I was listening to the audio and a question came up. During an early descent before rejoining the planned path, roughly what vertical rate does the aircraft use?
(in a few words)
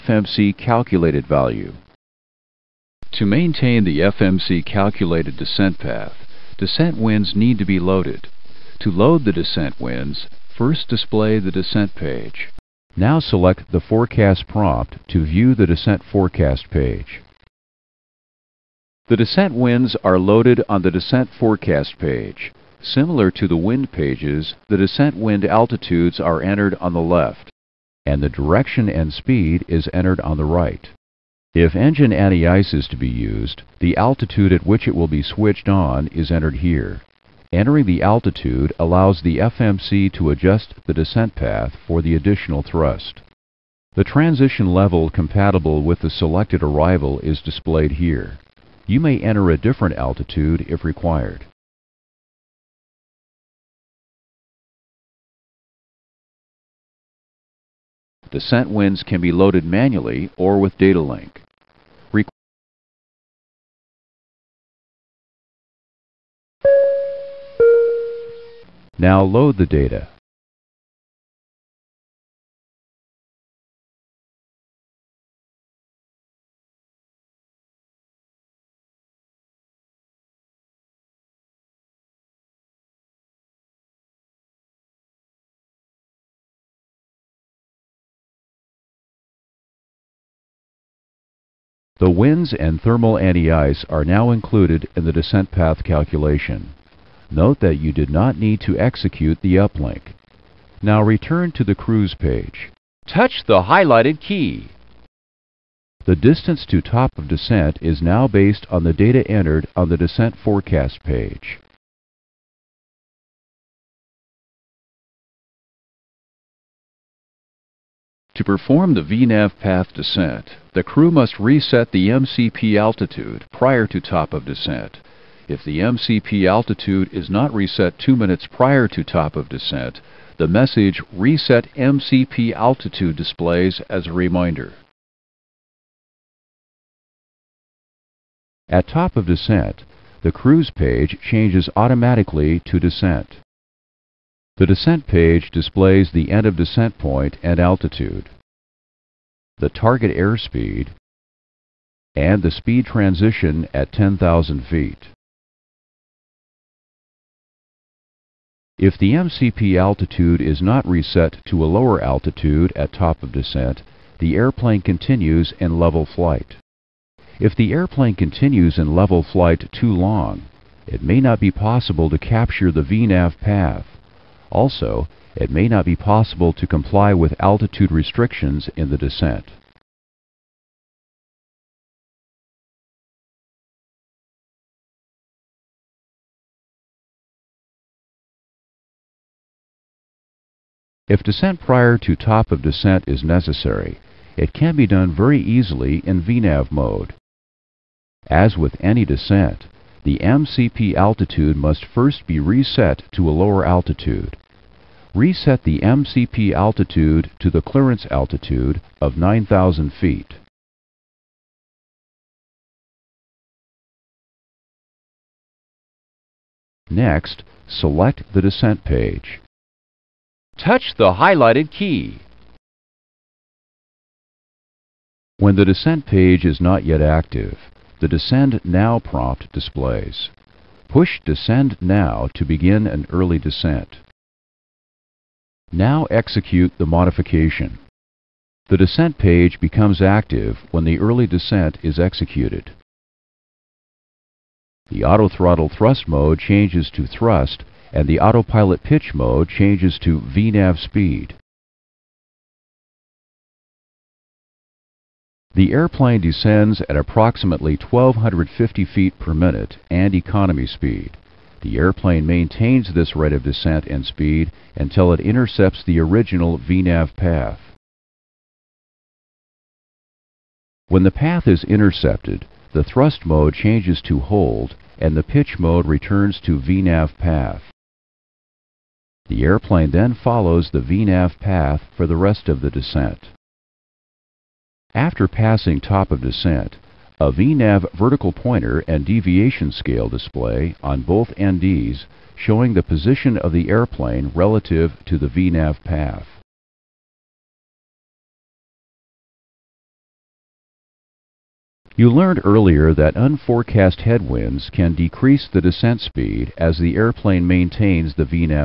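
1250 feet per minute.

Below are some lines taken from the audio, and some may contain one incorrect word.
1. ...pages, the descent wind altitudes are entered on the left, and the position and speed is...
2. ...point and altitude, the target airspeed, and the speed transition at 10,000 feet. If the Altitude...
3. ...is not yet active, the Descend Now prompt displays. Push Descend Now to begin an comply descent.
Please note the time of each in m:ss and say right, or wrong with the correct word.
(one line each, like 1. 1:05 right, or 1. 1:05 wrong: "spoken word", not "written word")
1. 0:23 wrong: "direction", not "position"
2. 2:26 wrong: "MCP", not "Altitude"
3. 3:46 wrong: "early", not "comply".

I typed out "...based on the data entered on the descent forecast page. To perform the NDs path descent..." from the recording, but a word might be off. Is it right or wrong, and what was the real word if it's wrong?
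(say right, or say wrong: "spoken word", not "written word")
wrong: "VNAV", not "NDs".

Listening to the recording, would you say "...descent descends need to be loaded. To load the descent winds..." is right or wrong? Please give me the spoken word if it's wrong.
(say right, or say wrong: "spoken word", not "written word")
wrong: "winds", not "descends".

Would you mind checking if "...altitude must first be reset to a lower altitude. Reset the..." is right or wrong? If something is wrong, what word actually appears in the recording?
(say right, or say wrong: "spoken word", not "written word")
right.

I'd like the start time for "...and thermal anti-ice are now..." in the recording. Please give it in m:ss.
1:32.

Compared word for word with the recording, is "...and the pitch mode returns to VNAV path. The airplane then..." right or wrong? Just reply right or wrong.
right.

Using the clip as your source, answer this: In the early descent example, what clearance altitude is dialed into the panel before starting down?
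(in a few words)
9,000 feet.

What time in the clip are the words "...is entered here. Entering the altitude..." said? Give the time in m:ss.
0:36.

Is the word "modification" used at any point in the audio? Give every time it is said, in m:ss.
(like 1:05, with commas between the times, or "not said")
3:56.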